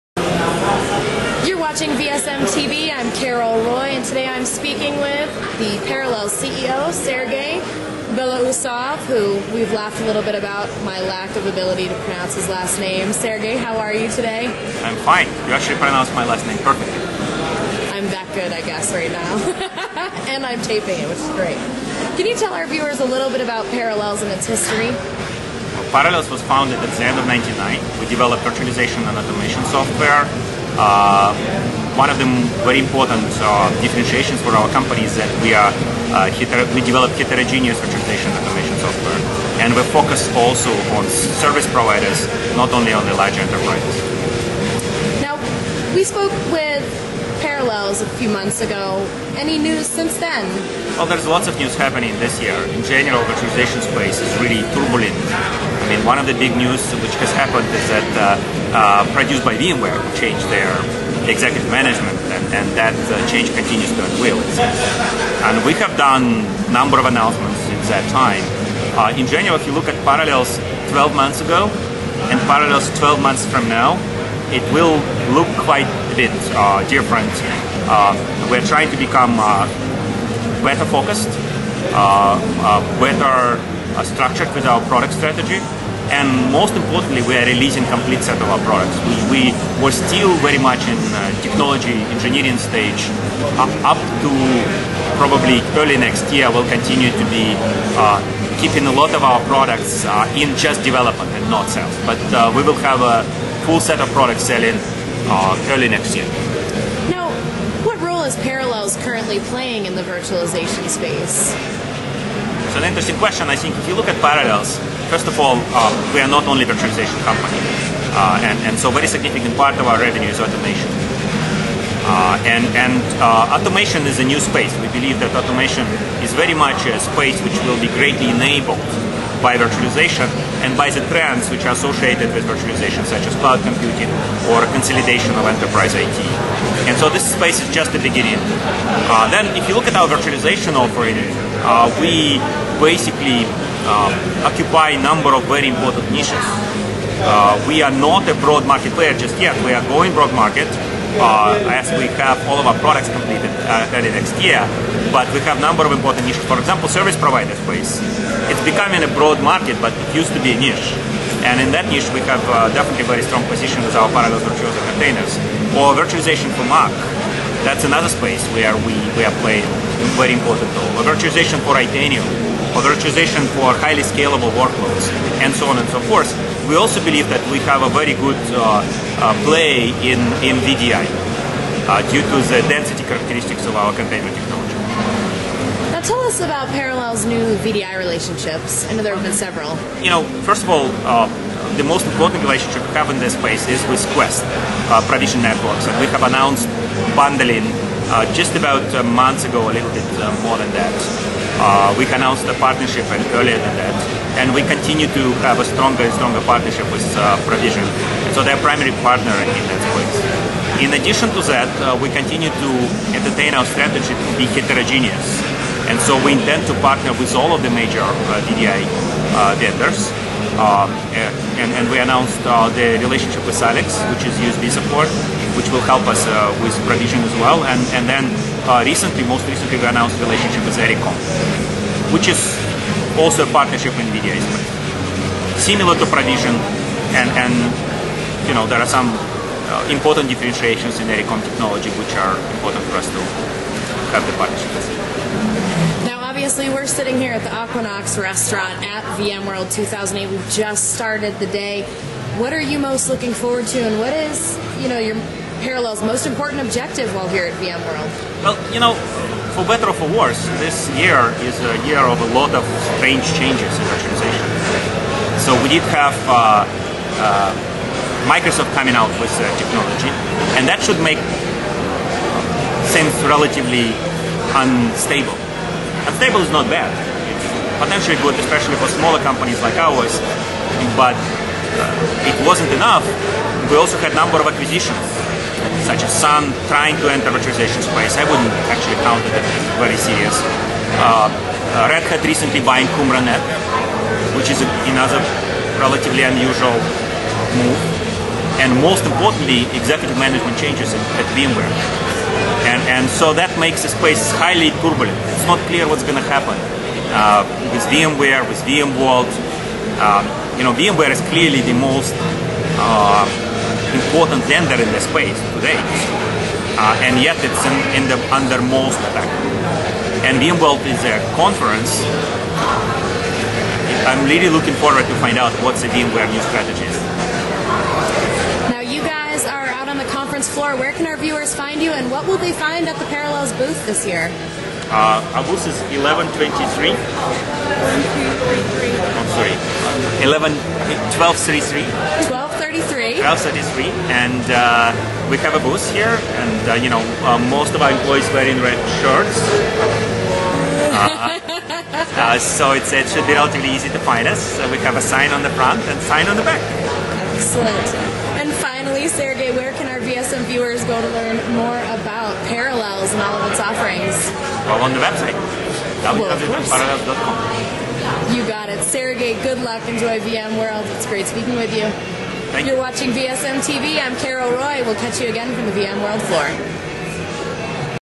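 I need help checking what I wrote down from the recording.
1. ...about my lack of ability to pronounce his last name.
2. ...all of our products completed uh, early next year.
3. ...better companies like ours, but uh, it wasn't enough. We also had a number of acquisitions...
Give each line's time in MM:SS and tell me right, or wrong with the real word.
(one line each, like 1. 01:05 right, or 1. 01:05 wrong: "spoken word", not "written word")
1. 00:10 right
2. 02:32 right
3. 04:38 wrong: "smaller", not "better".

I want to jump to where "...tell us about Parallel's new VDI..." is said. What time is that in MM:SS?
03:06.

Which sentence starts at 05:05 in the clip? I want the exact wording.
It's not clear what's going to happen uh, with VMware, with VMworld.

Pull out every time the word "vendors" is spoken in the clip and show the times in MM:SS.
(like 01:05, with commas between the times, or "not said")
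03:39, 05:14.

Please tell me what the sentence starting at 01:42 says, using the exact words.
But uh, we will have a full set of products selling uh, early next year.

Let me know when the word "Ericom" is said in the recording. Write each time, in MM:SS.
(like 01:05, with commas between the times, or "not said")
03:50, 04:01.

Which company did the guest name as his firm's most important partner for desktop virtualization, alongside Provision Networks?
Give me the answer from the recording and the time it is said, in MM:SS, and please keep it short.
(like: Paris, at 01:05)
Quest, at 03:14.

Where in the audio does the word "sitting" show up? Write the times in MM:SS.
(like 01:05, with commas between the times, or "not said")
04:06.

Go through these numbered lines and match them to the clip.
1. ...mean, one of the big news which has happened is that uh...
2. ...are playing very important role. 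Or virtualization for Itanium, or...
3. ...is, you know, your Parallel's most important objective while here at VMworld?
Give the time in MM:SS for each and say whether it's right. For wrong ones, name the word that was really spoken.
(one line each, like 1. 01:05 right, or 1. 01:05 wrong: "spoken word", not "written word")
1. 00:55 right
2. 02:49 right
3. 04:14 right.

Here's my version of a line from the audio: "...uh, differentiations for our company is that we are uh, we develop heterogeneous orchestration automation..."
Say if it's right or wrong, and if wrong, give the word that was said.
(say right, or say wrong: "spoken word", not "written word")
right.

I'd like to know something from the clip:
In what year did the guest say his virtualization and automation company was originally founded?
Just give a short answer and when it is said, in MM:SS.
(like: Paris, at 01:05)
1999, at 00:27.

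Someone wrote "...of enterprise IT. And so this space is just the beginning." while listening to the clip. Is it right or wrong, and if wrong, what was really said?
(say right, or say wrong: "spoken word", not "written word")
right.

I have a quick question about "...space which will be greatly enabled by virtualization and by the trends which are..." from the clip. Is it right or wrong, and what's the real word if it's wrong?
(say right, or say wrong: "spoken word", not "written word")
right.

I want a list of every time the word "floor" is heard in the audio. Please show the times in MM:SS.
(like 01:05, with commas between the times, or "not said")
05:30, 06:16.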